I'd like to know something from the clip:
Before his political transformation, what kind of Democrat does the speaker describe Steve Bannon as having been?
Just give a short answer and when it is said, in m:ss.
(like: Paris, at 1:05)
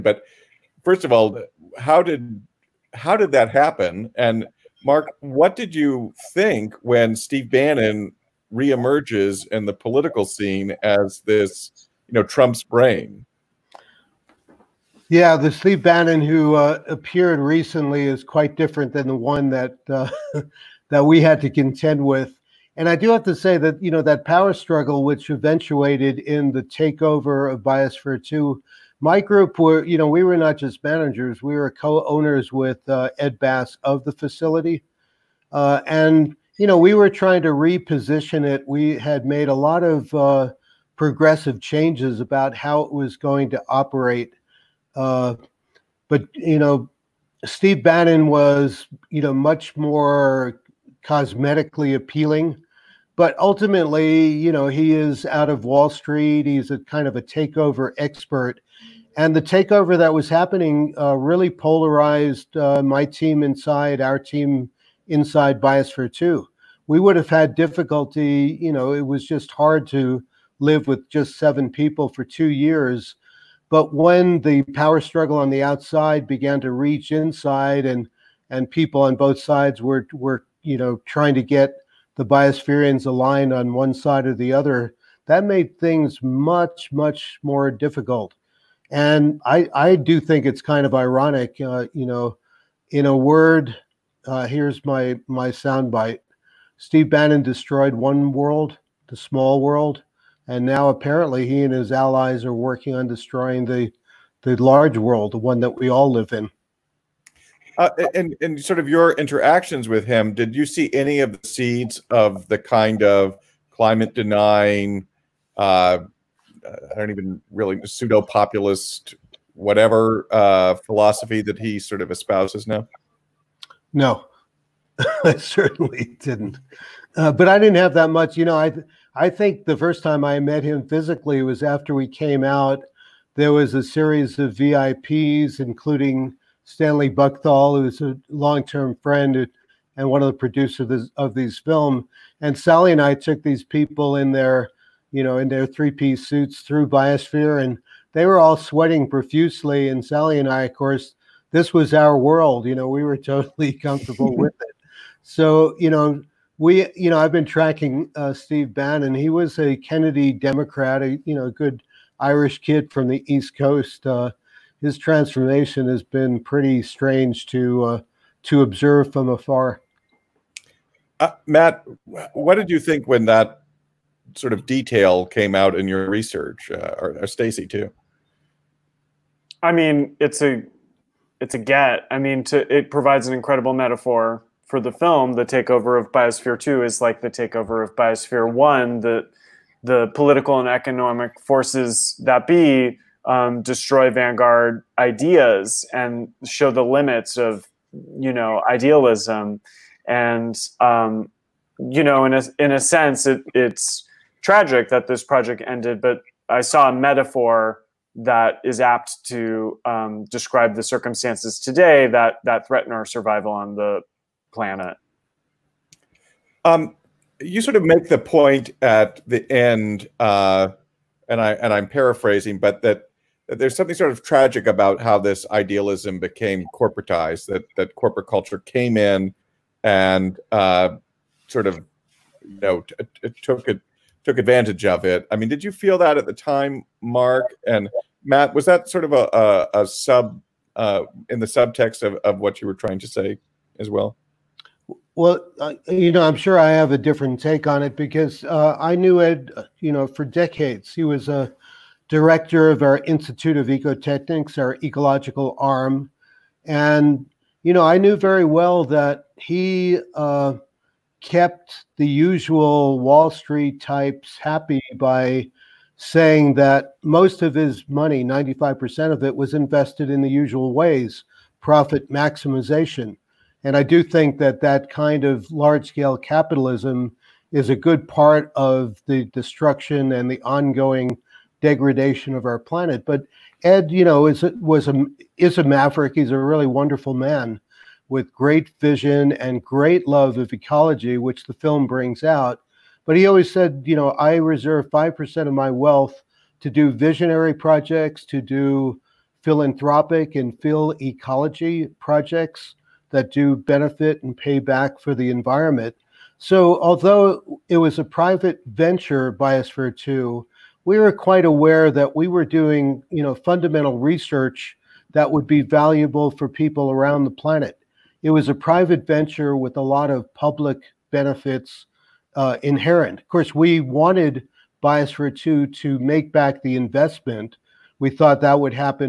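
Kennedy Democrat, at 2:39.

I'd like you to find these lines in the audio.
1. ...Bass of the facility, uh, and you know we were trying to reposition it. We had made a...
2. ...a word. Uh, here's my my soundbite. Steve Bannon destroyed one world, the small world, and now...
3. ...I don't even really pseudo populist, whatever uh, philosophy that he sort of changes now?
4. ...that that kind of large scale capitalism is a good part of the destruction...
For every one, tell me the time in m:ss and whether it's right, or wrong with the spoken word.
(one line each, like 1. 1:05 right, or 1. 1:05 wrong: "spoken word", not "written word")
1. 0:33 right
2. 1:33 right
3. 1:56 wrong: "espouses", not "changes"
4. 4:34 right.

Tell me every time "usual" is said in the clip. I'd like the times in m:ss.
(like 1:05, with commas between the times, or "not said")
4:22, 4:30.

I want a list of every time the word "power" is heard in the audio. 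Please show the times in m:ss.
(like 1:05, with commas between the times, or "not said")
0:24, 1:14.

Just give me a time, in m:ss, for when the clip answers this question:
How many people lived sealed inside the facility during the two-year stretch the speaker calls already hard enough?
1:11.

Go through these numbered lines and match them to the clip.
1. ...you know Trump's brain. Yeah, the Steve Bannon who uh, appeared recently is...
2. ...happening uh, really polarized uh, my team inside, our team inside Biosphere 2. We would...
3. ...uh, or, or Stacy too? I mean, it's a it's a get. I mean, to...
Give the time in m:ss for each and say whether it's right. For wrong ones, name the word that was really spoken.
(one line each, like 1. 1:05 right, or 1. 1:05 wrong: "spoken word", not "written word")
1. 0:12 right
2. 1:00 right
3. 2:56 right.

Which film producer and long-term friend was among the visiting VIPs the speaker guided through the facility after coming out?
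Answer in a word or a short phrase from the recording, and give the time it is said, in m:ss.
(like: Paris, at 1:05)
Stanley Buchthal, at 2:16.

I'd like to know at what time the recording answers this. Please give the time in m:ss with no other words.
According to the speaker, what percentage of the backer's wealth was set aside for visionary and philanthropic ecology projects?
4:54.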